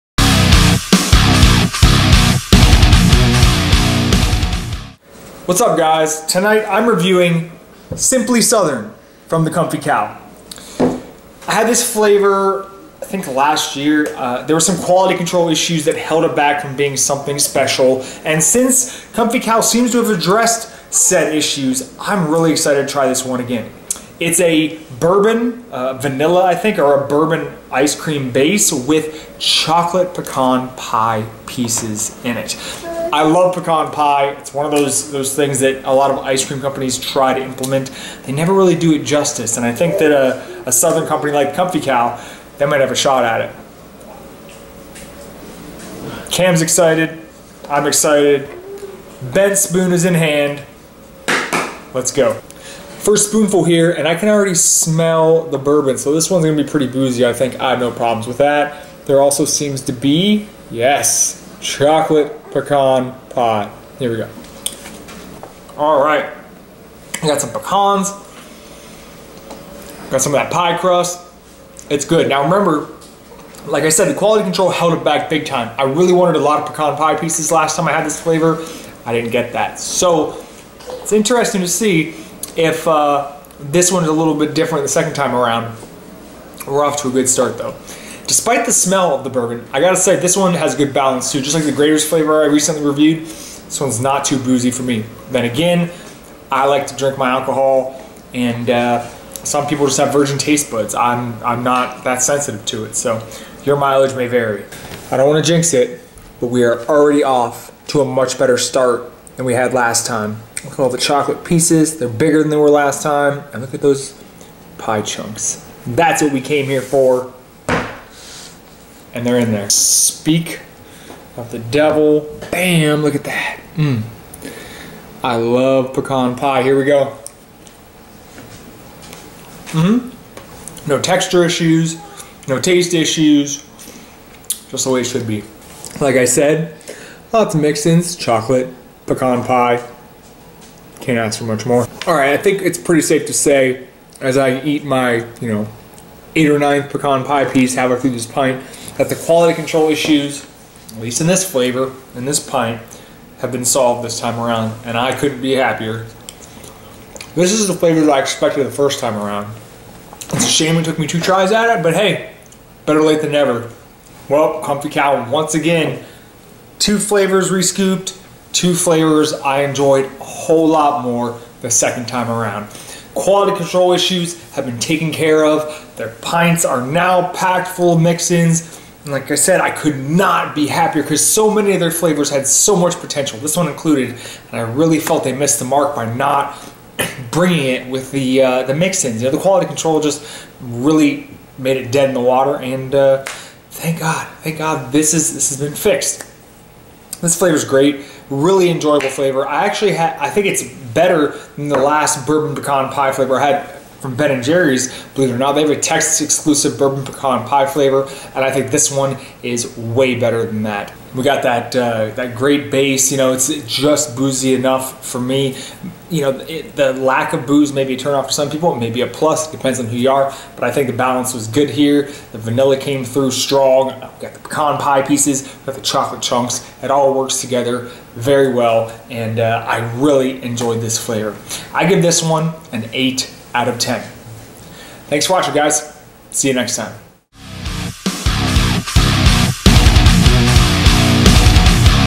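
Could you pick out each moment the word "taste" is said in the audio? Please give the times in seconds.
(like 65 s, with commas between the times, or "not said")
100 s, 132 s.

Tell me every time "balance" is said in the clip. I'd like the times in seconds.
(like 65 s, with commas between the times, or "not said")
90 s, 220 s.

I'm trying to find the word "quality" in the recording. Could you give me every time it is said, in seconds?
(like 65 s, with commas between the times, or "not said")
14 s, 74 s, 149 s, 173 s, 189 s.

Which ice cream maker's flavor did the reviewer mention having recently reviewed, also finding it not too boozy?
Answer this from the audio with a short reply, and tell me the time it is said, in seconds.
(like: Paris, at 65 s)
Graeter's, at 91 s.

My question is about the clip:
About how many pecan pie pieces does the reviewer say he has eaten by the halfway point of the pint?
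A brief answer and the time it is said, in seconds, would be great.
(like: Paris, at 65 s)
8 or 9, at 146 s.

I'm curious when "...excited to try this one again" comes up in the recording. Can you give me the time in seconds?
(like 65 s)
22 s.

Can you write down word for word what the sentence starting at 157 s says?
This is the flavor that I expected the first time around.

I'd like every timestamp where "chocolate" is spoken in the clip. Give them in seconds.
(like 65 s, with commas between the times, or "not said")
29 s, 61 s, 110 s, 138 s, 225 s.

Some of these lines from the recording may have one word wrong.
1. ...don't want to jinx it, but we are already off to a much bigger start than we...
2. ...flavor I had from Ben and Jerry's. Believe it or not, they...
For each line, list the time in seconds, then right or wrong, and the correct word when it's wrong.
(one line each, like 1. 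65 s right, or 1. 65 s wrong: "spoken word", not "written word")
1. 105 s wrong: "better", not "bigger"
2. 203 s right.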